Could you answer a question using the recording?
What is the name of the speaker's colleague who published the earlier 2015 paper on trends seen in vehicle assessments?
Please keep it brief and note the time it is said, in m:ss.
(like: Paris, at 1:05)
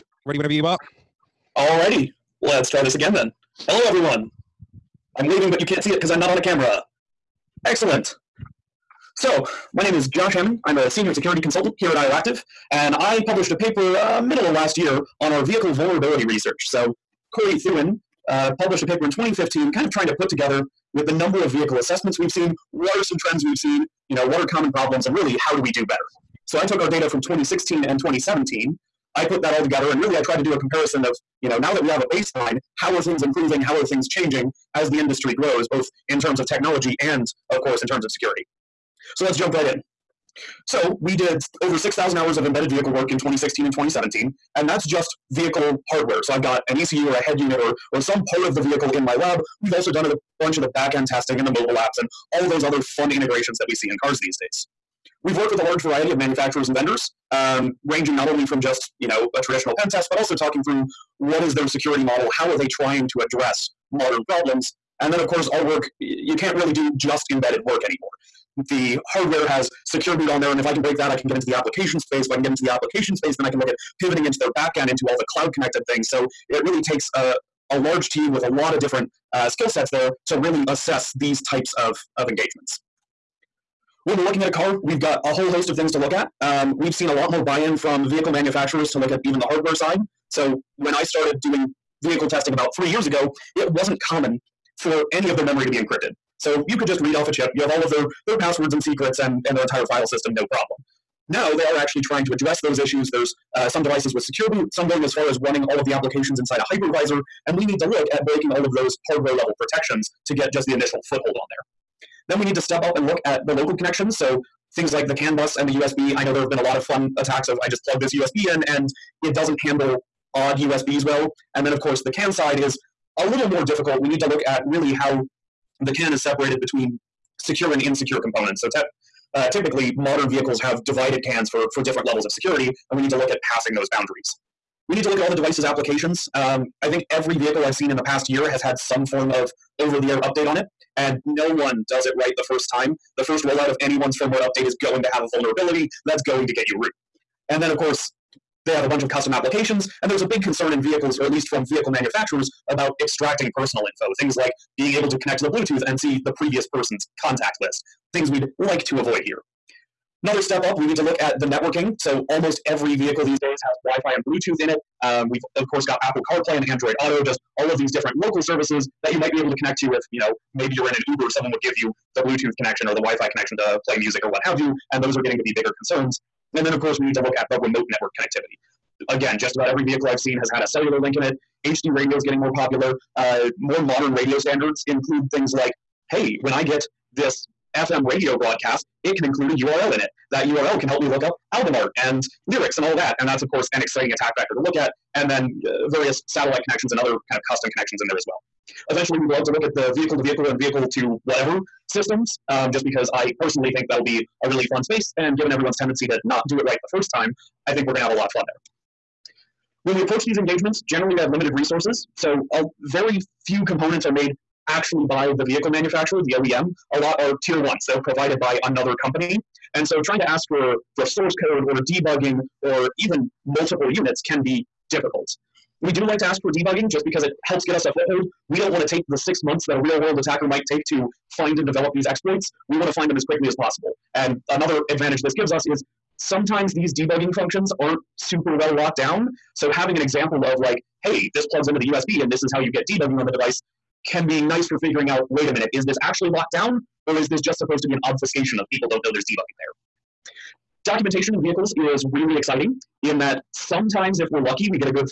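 Corey Thuen, at 0:17.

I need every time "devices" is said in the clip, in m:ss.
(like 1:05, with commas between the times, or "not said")
1:43, 2:15, 4:03.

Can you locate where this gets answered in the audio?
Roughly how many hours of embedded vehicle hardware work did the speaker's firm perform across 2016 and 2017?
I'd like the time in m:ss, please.
0:41.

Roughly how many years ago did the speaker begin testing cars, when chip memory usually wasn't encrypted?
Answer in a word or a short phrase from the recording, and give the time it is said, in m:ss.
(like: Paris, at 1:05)
3 years, at 1:32.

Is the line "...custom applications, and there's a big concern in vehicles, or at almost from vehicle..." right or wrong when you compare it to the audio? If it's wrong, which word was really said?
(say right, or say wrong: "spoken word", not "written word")
wrong: "least", not "almost".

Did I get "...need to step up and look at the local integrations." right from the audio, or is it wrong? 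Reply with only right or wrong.
wrong.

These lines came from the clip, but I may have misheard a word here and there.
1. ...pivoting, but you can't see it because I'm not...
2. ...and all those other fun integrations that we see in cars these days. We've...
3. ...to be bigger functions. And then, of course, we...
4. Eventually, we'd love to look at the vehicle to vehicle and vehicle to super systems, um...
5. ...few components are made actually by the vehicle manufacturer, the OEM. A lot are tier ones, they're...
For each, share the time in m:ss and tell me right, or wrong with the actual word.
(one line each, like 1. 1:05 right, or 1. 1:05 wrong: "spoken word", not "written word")
1. 0:05 wrong: "waving", not "pivoting"
2. 0:52 right
3. 2:55 wrong: "concerns", not "functions"
4. 3:18 wrong: "whatever", not "super"
5. 3:33 right.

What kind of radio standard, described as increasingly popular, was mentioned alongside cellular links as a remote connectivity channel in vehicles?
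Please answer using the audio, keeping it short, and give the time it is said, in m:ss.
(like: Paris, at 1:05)
HD radio, at 3:01.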